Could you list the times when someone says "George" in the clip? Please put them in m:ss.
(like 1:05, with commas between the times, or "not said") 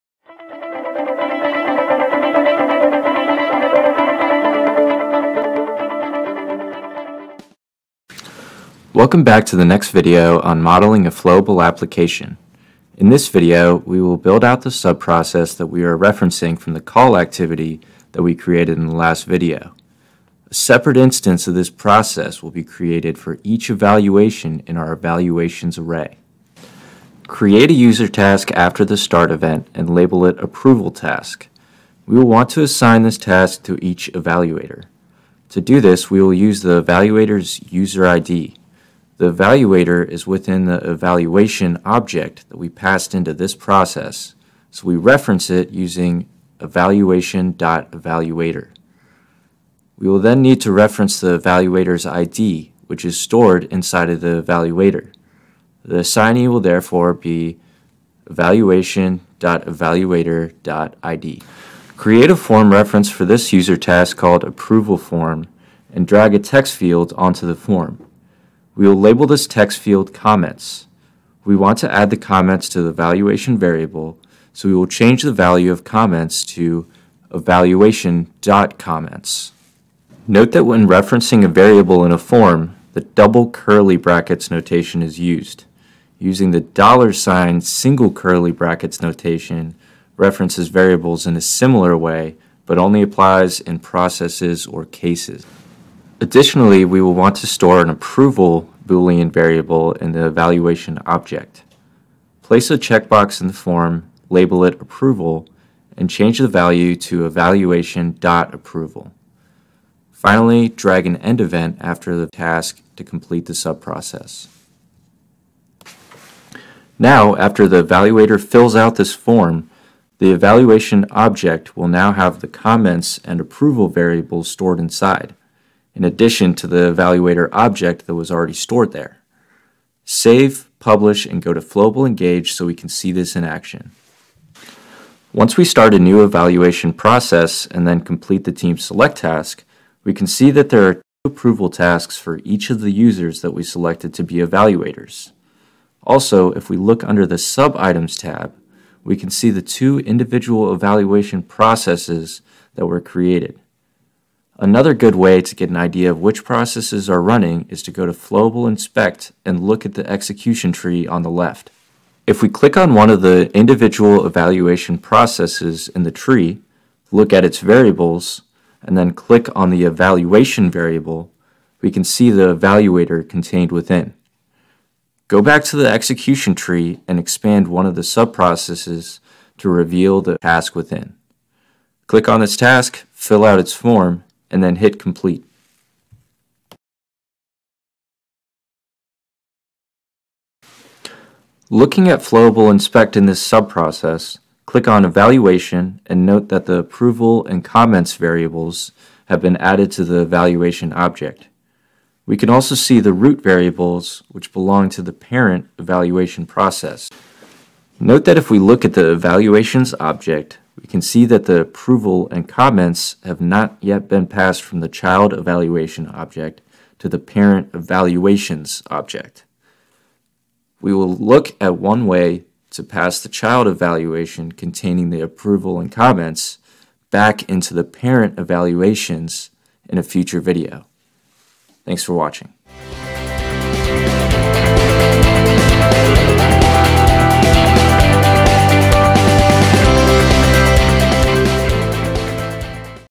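not said.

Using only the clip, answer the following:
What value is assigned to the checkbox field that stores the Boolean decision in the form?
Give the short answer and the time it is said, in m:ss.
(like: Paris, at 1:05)
evaluation.approval, at 1:47.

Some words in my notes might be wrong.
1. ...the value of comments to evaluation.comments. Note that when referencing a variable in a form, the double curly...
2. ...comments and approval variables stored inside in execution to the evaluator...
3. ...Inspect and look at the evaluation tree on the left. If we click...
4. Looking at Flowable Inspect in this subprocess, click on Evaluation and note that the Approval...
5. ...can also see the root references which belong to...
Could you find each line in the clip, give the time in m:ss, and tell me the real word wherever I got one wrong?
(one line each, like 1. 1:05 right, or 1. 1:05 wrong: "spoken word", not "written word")
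1. 1:15 right
2. 2:02 wrong: "addition", not "execution"
3. 2:38 wrong: "execution", not "evaluation"
4. 3:11 right
5. 3:22 wrong: "variables", not "references".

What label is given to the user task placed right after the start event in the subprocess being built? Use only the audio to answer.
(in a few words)
approval task.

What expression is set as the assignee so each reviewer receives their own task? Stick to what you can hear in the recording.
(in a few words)
evaluation.evaluator.id.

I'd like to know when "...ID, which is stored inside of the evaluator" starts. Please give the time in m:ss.
0:52.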